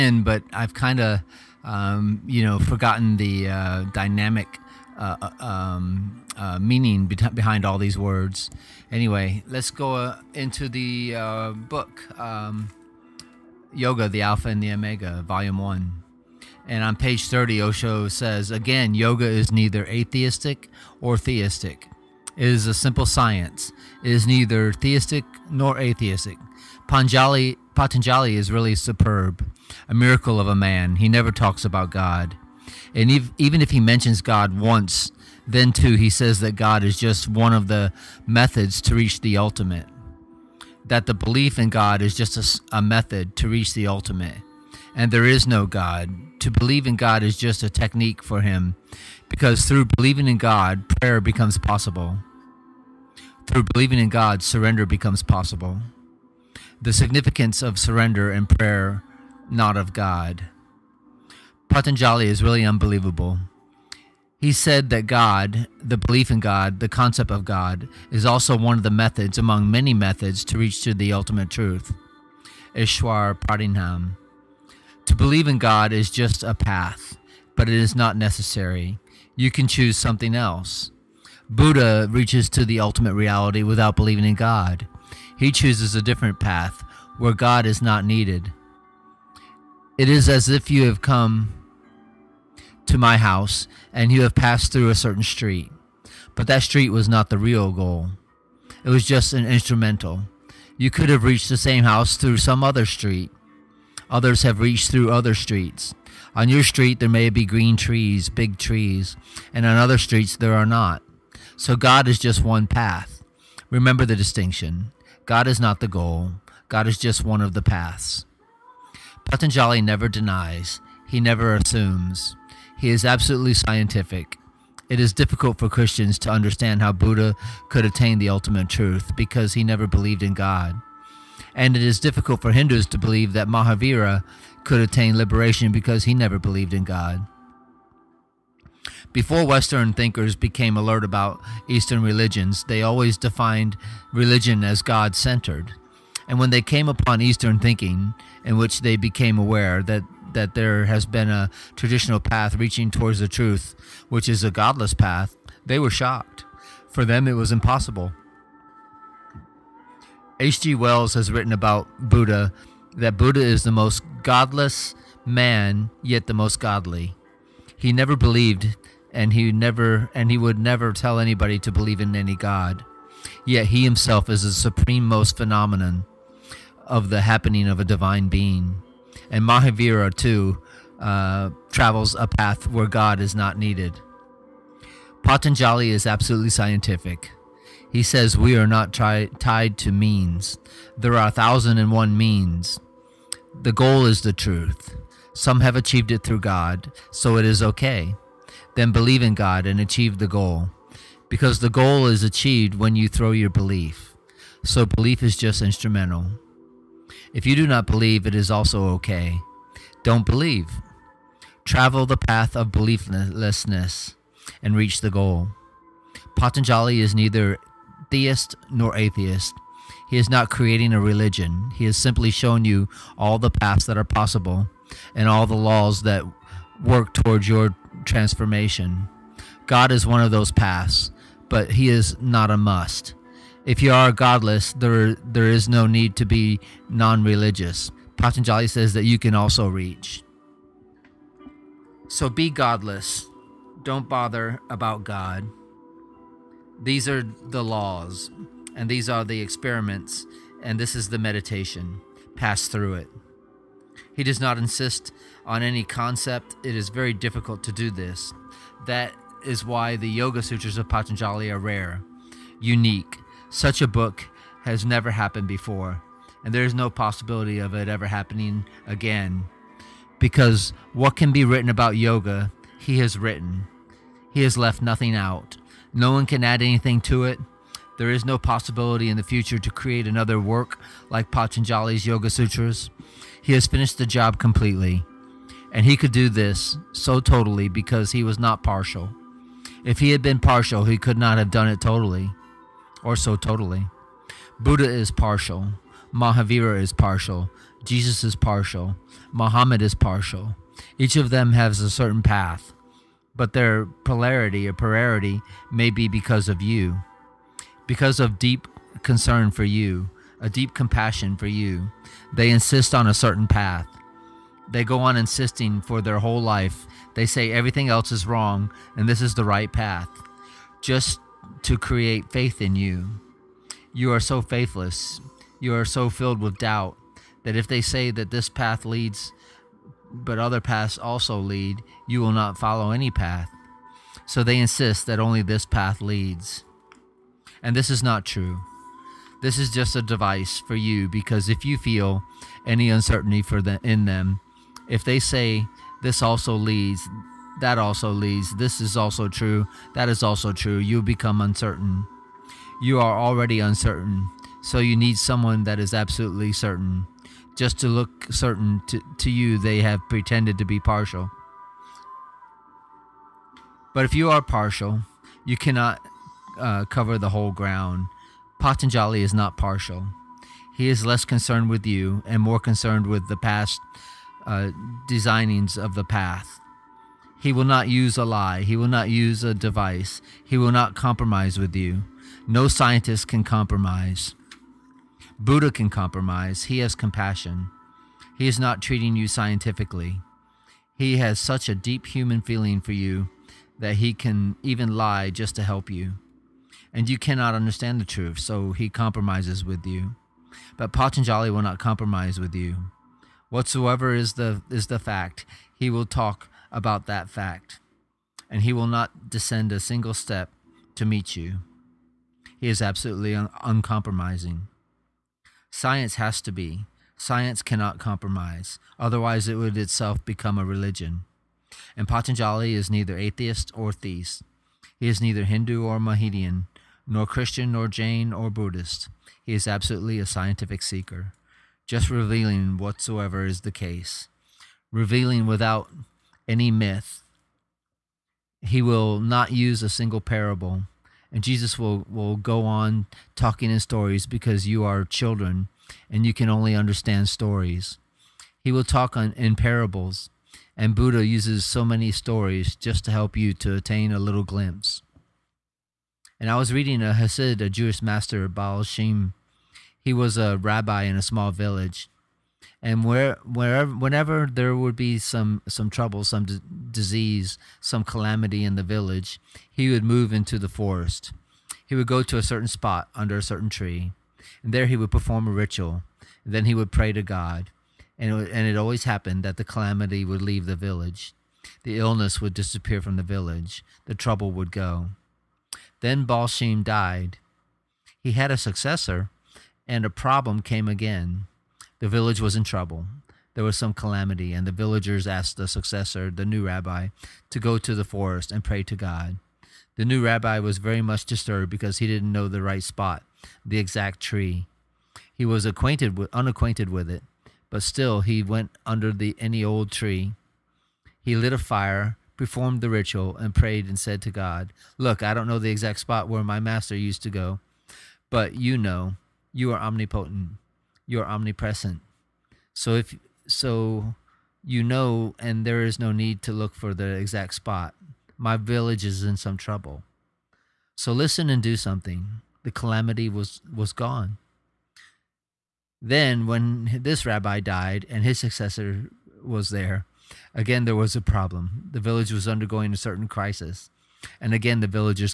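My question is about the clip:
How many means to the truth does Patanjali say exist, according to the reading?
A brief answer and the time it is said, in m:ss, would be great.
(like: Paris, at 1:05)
1001, at 3:11.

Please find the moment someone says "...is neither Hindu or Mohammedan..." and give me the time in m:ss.
7:05.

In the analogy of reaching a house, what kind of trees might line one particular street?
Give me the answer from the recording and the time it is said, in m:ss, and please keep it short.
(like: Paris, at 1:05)
green trees, at 1:47.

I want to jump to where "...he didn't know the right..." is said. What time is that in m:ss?
8:21.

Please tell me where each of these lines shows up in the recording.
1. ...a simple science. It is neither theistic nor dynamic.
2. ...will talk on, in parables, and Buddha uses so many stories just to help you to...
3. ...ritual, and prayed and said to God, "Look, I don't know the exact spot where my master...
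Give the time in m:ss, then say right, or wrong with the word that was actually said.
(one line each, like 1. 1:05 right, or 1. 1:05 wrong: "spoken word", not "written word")
1. 0:22 wrong: "atheistic", not "dynamic"
2. 7:28 right
3. 8:32 right.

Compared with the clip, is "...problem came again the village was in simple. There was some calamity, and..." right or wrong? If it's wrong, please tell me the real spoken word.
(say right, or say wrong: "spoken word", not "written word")
wrong: "trouble", not "simple".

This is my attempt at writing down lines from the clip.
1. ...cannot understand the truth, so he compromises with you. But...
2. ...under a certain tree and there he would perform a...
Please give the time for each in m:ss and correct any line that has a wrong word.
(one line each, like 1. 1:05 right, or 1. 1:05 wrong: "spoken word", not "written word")
1. 6:37 right
2. 7:53 right.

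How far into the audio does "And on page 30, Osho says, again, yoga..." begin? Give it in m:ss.
0:16.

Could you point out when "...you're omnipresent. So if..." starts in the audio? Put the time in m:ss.
8:41.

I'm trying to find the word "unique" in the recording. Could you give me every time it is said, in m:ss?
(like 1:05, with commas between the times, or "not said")
4:22.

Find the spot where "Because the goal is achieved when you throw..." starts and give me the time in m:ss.
3:21.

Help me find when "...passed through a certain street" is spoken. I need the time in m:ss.
1:34.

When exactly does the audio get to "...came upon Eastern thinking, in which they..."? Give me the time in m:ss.
2:26.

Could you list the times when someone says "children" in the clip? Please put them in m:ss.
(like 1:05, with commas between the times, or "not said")
7:25.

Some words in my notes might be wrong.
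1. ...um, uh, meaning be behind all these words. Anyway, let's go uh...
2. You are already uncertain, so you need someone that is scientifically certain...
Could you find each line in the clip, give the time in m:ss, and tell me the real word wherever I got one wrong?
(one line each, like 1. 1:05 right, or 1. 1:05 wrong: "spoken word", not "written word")
1. 0:05 right
2. 5:52 wrong: "absolutely", not "scientifically".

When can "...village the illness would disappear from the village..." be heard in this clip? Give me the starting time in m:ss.
8:00.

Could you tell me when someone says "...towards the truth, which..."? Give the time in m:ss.
2:32.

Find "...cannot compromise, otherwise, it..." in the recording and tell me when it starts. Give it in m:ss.
6:57.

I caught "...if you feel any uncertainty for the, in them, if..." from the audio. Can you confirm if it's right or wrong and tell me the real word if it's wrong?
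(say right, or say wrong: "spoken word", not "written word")
right.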